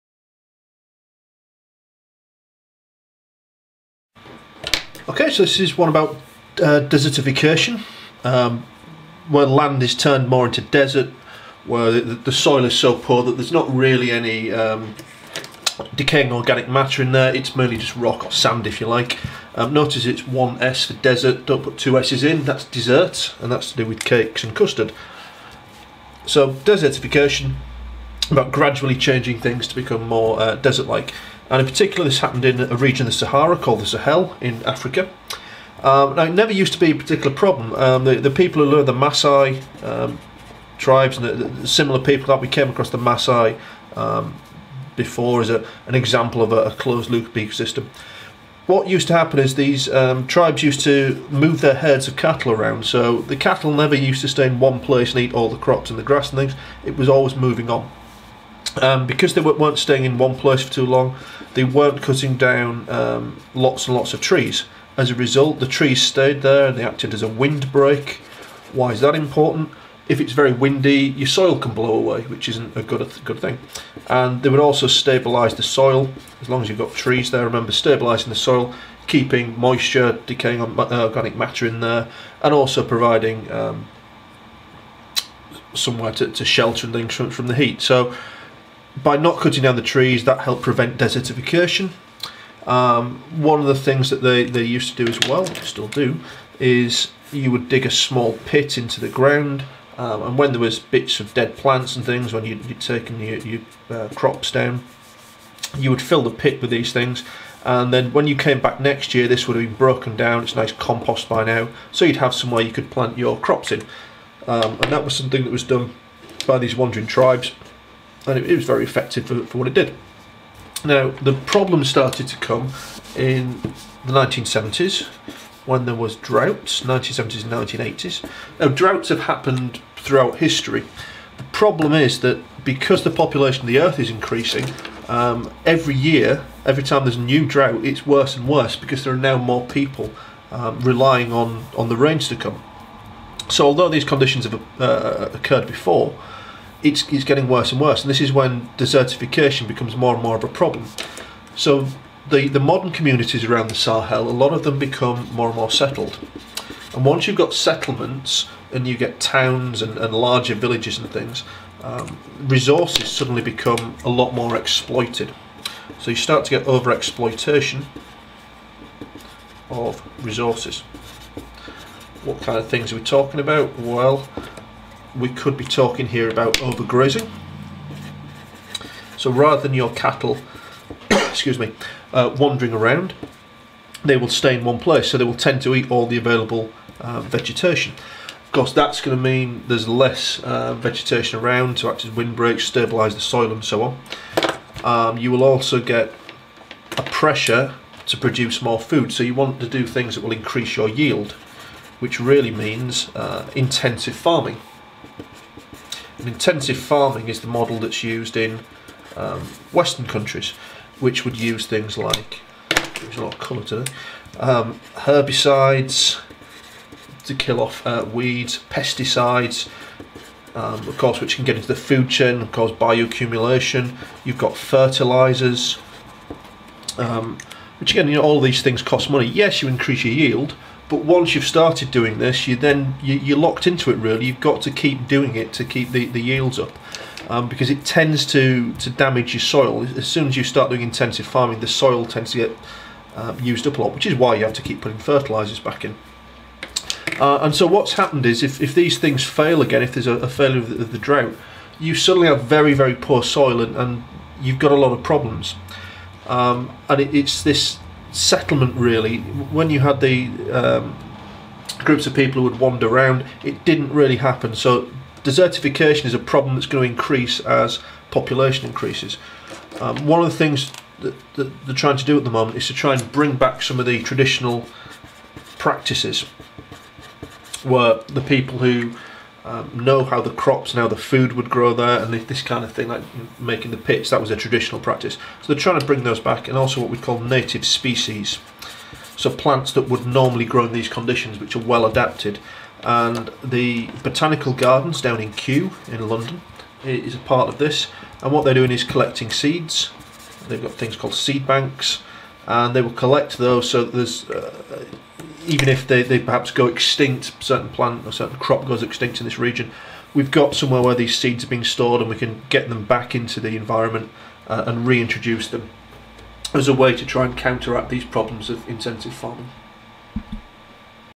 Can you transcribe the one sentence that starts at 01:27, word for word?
So by not cutting down the trees, that helped prevent desertification.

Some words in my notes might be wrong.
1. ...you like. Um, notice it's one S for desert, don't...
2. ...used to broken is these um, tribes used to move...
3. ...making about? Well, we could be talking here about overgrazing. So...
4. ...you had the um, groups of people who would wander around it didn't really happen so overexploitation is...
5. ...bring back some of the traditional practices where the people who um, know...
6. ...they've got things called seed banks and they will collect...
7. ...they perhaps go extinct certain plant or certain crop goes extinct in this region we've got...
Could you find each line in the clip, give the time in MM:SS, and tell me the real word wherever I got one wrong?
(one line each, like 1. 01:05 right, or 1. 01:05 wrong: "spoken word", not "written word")
1. 00:18 right
2. 00:48 wrong: "happen", not "broken"
3. 02:53 wrong: "talking", not "making"
4. 04:19 wrong: "desertification", not "overexploitation"
5. 04:33 right
6. 05:00 right
7. 05:06 right.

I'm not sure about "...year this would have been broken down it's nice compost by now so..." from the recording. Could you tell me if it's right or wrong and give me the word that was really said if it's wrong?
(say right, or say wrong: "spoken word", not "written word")
right.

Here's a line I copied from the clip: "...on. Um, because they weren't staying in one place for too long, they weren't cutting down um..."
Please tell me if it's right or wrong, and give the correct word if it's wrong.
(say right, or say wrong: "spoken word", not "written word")
right.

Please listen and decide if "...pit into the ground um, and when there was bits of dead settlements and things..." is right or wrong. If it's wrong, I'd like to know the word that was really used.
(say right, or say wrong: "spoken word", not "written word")
wrong: "plants", not "settlements".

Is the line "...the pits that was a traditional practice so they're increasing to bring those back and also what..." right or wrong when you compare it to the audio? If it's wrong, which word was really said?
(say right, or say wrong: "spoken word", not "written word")
wrong: "trying", not "increasing".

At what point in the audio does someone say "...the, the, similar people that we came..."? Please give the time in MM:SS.
00:41.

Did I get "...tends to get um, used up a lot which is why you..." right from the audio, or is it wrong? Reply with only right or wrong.
right.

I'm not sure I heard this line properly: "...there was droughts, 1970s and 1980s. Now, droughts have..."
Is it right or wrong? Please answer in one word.
right.